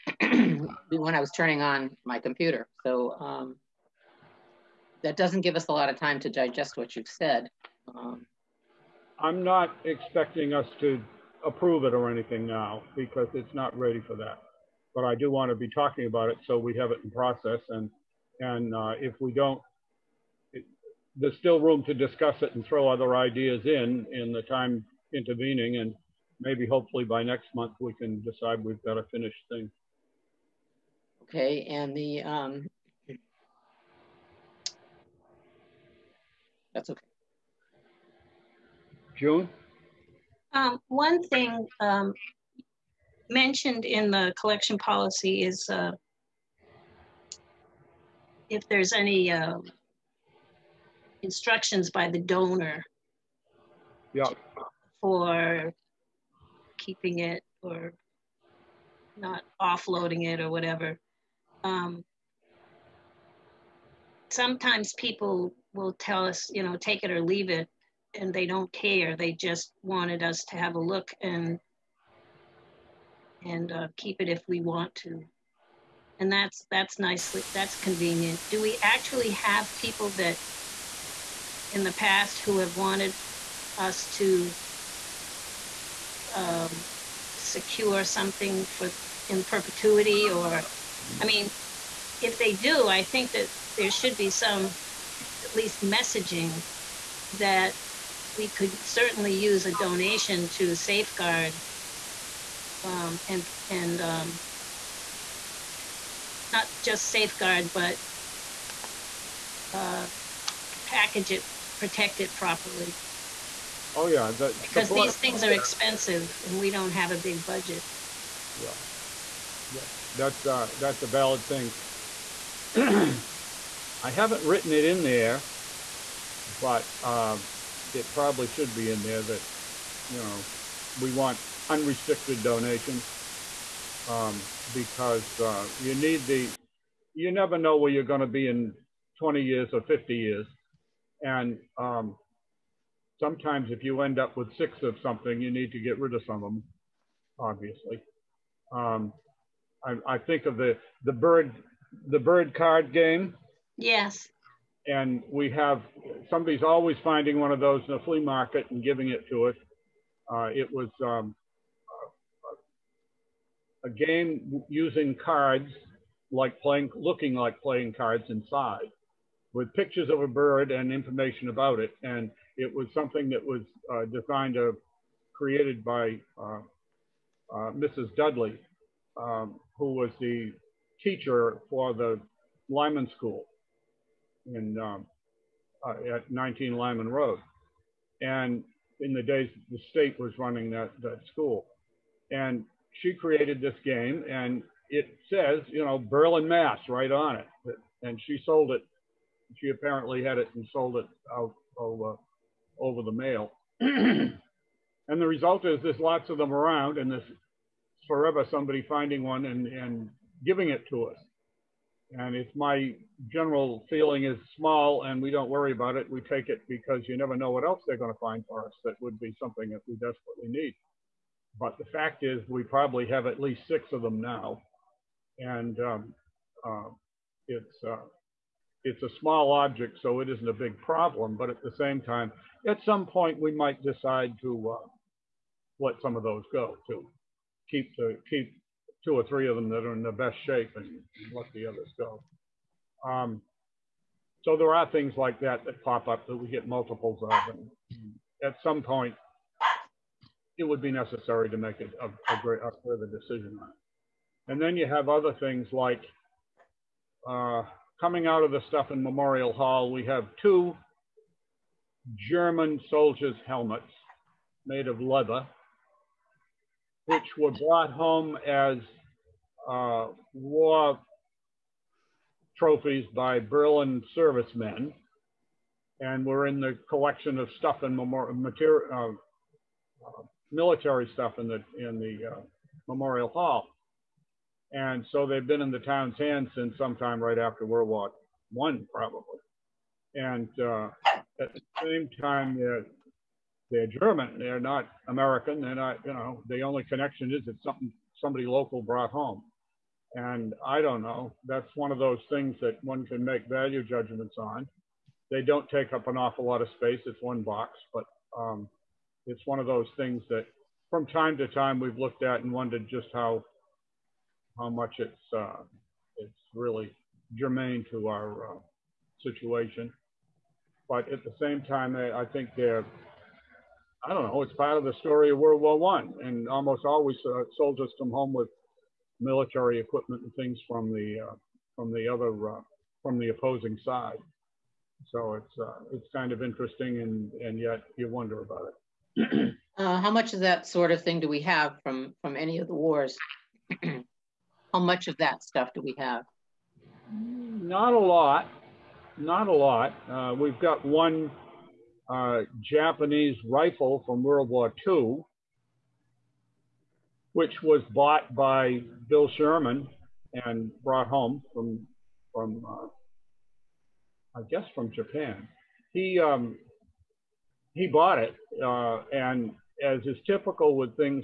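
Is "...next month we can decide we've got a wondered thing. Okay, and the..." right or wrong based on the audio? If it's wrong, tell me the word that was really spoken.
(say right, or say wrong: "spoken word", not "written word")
wrong: "finished", not "wondered".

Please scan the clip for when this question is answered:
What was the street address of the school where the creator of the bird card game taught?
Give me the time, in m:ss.
3:06.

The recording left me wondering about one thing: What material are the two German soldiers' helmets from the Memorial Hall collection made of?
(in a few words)
Leather.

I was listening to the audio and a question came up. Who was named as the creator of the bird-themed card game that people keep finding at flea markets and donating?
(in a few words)
Mrs. Dudley.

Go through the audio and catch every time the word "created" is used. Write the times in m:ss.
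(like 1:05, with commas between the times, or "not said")
2:55, 3:13.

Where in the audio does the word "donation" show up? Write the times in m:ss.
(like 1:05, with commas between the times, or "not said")
1:39, 2:12.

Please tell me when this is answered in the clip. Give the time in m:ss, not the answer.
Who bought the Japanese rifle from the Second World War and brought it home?
5:59.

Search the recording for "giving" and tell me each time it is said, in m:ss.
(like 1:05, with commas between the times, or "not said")
2:38, 3:30.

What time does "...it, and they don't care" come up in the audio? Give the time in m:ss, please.
1:07.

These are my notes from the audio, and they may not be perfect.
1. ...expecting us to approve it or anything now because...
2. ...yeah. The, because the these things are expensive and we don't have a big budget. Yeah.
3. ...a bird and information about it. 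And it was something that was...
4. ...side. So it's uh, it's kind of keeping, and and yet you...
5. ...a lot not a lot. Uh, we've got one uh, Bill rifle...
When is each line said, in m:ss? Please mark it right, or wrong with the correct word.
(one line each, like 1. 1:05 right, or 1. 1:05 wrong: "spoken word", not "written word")
1. 0:09 right
2. 1:54 right
3. 2:50 right
4. 5:33 wrong: "interesting", not "keeping"
5. 5:47 wrong: "Japanese", not "Bill".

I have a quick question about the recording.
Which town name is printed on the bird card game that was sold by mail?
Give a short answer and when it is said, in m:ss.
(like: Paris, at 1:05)
Berlin, Mass, at 3:15.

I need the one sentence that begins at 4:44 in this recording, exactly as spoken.
And so they've been in the town's hands since sometime right after World War One, probably.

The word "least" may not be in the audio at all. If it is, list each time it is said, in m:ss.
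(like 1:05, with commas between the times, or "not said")
1:35, 3:43.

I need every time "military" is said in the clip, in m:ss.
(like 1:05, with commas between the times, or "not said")
4:40, 5:29.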